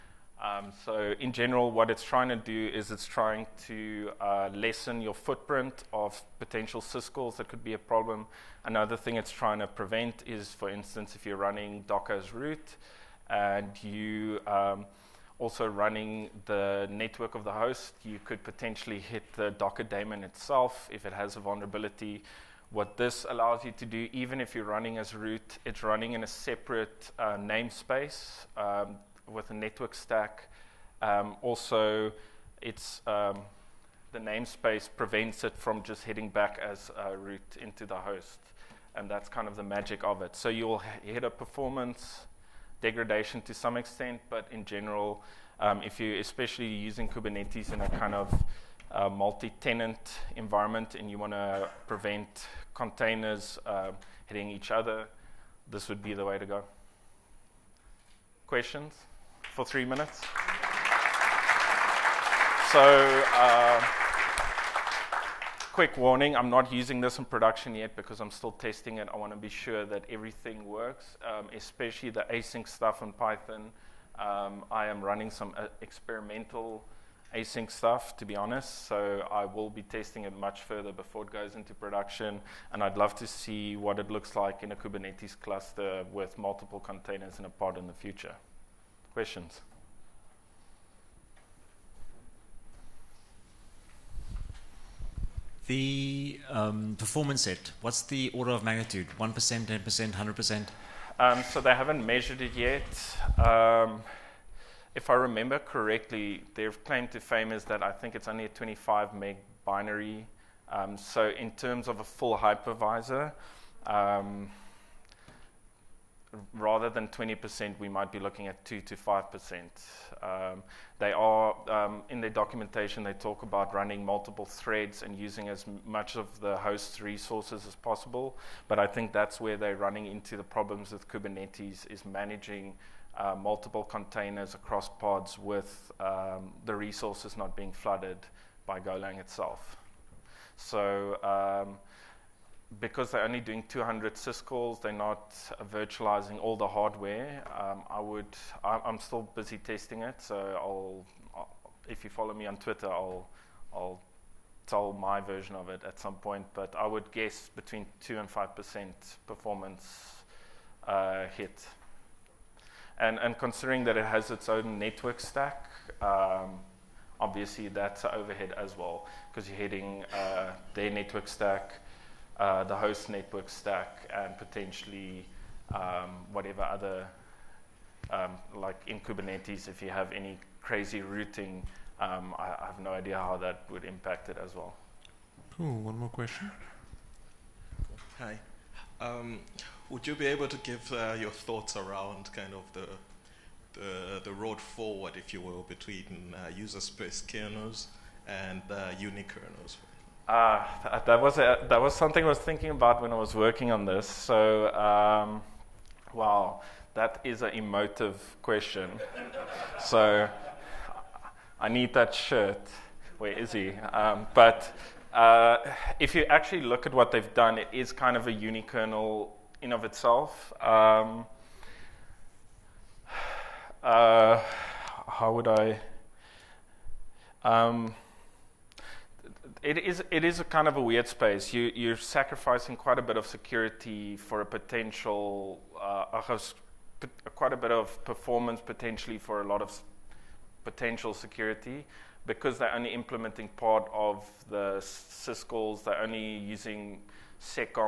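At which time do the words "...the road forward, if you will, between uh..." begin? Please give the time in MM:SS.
03:14.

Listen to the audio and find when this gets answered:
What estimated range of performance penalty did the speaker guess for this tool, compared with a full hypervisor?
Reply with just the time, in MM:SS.
01:58.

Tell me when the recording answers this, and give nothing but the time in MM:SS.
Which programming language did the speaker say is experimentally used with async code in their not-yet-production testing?
01:13.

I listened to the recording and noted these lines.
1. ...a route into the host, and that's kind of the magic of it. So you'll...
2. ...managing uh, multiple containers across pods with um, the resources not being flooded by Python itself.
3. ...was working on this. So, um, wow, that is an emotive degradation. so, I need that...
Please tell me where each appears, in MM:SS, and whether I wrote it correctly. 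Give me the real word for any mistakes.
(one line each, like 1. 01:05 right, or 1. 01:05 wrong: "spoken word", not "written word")
1. 00:36 right
2. 02:12 wrong: "Golang", not "Python"
3. 03:23 wrong: "question", not "degradation".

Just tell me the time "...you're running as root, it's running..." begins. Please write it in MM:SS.
00:24.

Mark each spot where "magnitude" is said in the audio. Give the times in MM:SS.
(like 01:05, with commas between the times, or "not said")
01:38.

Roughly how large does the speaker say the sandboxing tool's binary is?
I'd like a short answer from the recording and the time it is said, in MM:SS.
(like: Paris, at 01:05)
25 meg, at 01:48.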